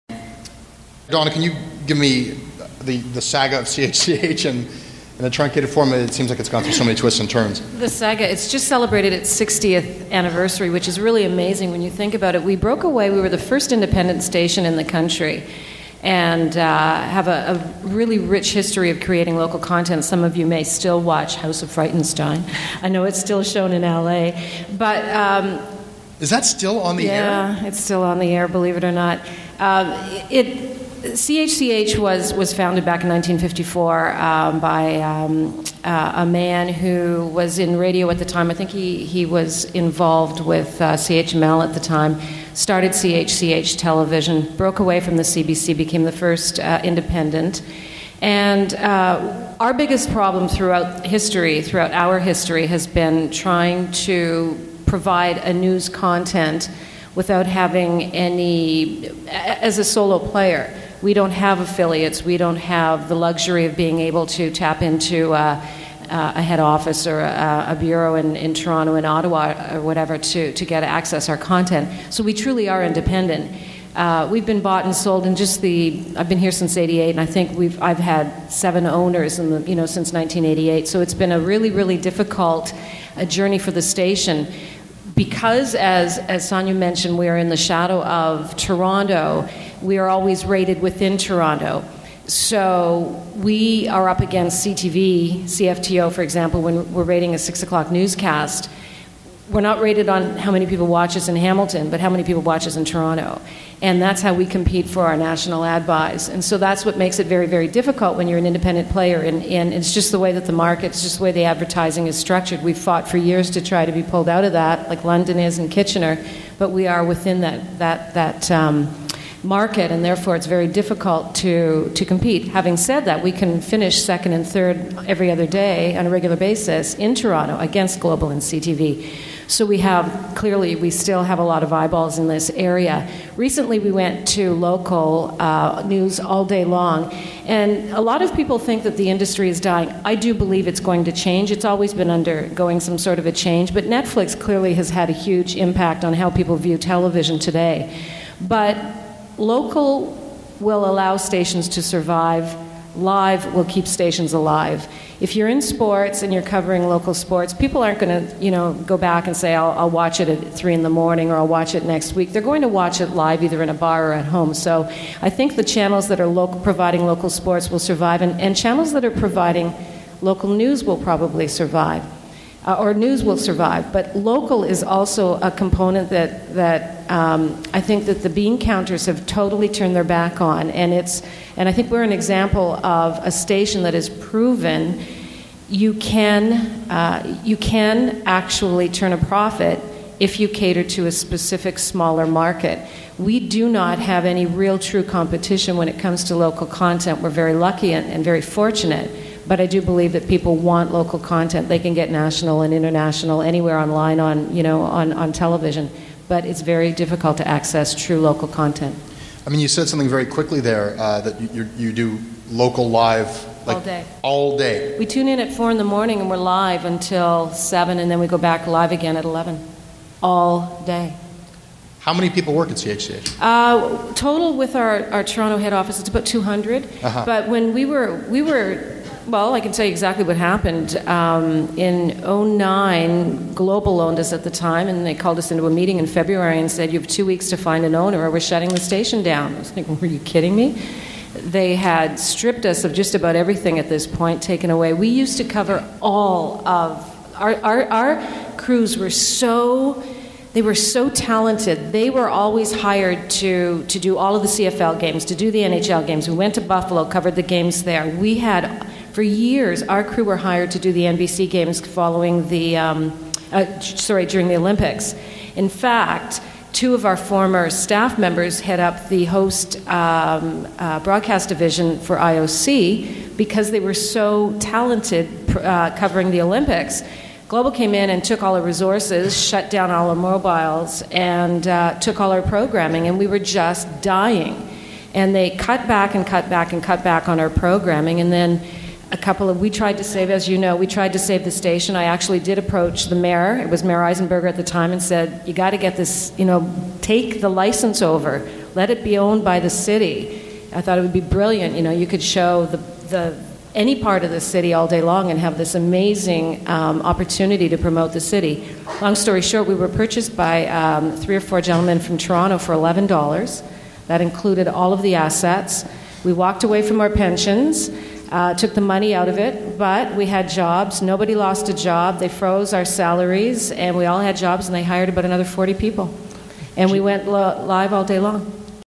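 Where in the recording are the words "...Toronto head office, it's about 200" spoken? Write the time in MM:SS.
03:45.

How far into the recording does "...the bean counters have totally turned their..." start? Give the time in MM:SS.
02:58.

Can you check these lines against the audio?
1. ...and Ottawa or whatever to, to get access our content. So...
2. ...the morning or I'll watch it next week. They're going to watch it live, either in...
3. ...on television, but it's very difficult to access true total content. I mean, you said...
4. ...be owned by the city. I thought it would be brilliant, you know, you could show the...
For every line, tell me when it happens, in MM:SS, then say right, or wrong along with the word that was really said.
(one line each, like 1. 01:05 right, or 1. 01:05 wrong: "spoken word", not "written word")
1. 01:08 right
2. 02:40 right
3. 03:25 wrong: "local", not "total"
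4. 04:59 right.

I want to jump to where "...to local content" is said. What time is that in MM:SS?
03:16.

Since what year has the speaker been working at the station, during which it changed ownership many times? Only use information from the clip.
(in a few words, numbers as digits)
1988.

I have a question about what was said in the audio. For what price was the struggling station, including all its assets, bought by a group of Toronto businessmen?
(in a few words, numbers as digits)
$11.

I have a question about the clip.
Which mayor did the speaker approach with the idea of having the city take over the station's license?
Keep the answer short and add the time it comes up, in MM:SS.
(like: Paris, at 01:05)
Mayor Eisenberger, at 04:53.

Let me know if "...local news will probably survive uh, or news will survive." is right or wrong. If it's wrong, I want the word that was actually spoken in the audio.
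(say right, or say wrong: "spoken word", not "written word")
right.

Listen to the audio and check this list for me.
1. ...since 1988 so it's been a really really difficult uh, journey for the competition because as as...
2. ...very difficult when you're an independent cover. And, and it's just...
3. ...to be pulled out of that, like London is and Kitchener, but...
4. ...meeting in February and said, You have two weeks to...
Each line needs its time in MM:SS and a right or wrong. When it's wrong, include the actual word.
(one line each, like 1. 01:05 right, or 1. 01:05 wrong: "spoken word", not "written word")
1. 01:19 wrong: "station", not "competition"
2. 01:47 wrong: "player", not "cover"
3. 01:53 right
4. 03:55 right.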